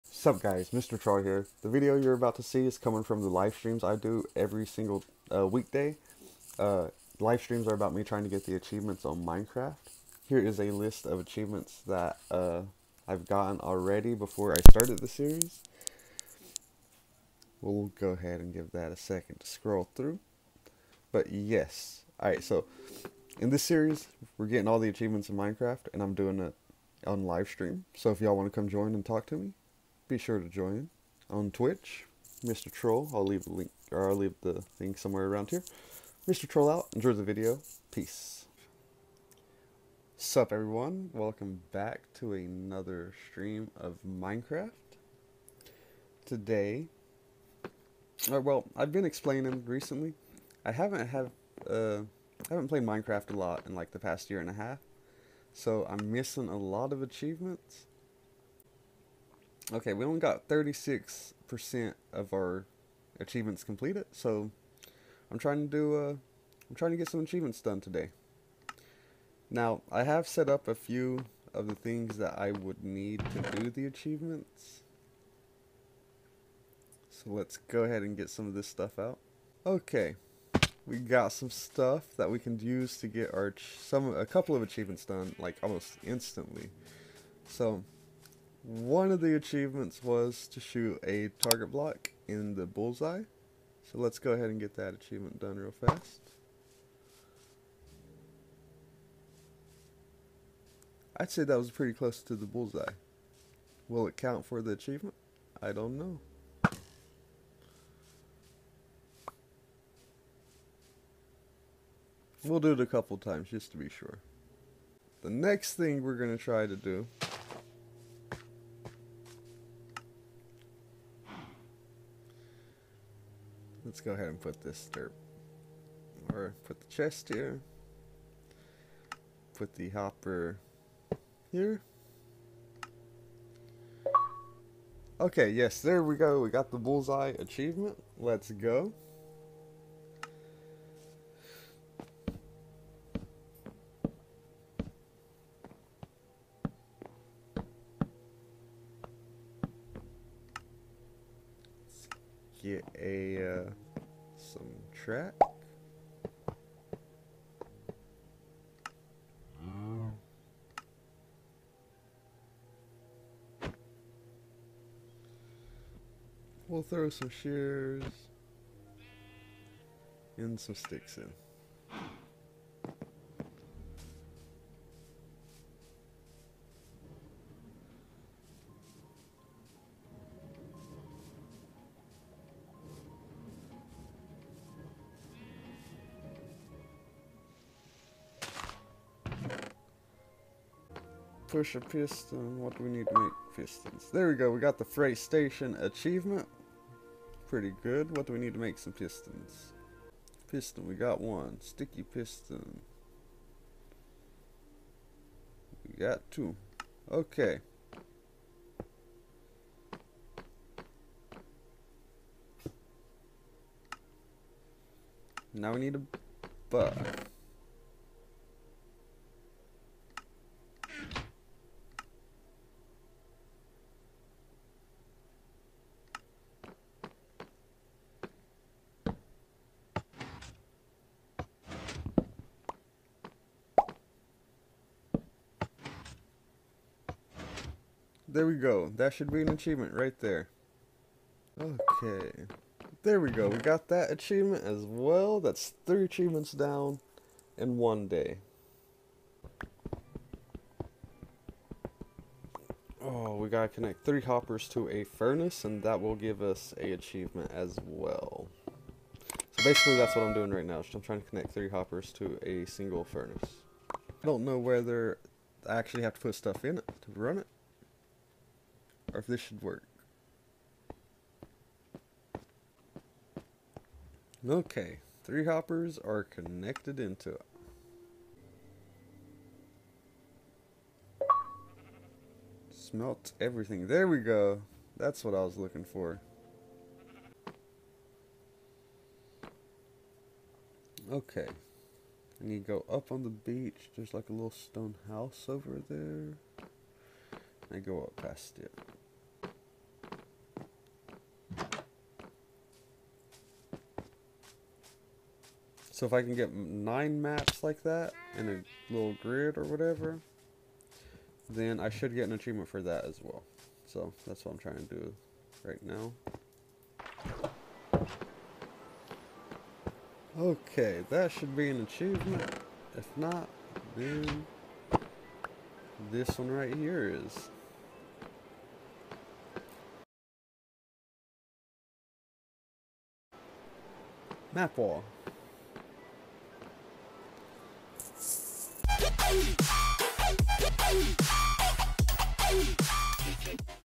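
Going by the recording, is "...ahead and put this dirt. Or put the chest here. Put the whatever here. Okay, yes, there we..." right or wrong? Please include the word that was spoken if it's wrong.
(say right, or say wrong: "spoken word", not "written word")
wrong: "hopper", not "whatever".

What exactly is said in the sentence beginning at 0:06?
Uh, live streams are about me trying to get the achievements on Minecraft.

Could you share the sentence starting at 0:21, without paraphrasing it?
But yes, alright, so in this series, we're getting all the achievements in Minecraft and I'm doing it on live stream.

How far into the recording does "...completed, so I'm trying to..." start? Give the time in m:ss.
1:03.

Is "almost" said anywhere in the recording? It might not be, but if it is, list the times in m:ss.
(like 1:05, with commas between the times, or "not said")
1:25.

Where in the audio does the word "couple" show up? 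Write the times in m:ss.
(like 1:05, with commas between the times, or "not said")
1:24, 1:52.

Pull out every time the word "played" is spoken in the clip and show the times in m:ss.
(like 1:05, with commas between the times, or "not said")
0:52.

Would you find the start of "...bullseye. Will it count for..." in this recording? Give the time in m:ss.
1:42.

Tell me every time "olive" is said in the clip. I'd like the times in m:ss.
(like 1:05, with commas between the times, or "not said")
not said.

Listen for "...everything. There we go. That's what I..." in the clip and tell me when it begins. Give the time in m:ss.
4:43.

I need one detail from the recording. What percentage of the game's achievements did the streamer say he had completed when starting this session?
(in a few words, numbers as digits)
36%.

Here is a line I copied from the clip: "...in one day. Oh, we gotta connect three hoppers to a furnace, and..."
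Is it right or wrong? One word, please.
right.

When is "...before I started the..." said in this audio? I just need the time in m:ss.
0:14.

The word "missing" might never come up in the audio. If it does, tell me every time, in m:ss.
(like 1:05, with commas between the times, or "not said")
0:56.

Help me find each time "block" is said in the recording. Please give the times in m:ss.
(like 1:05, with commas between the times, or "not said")
1:31.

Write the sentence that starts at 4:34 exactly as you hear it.
Okay, three hoppers are connected into it.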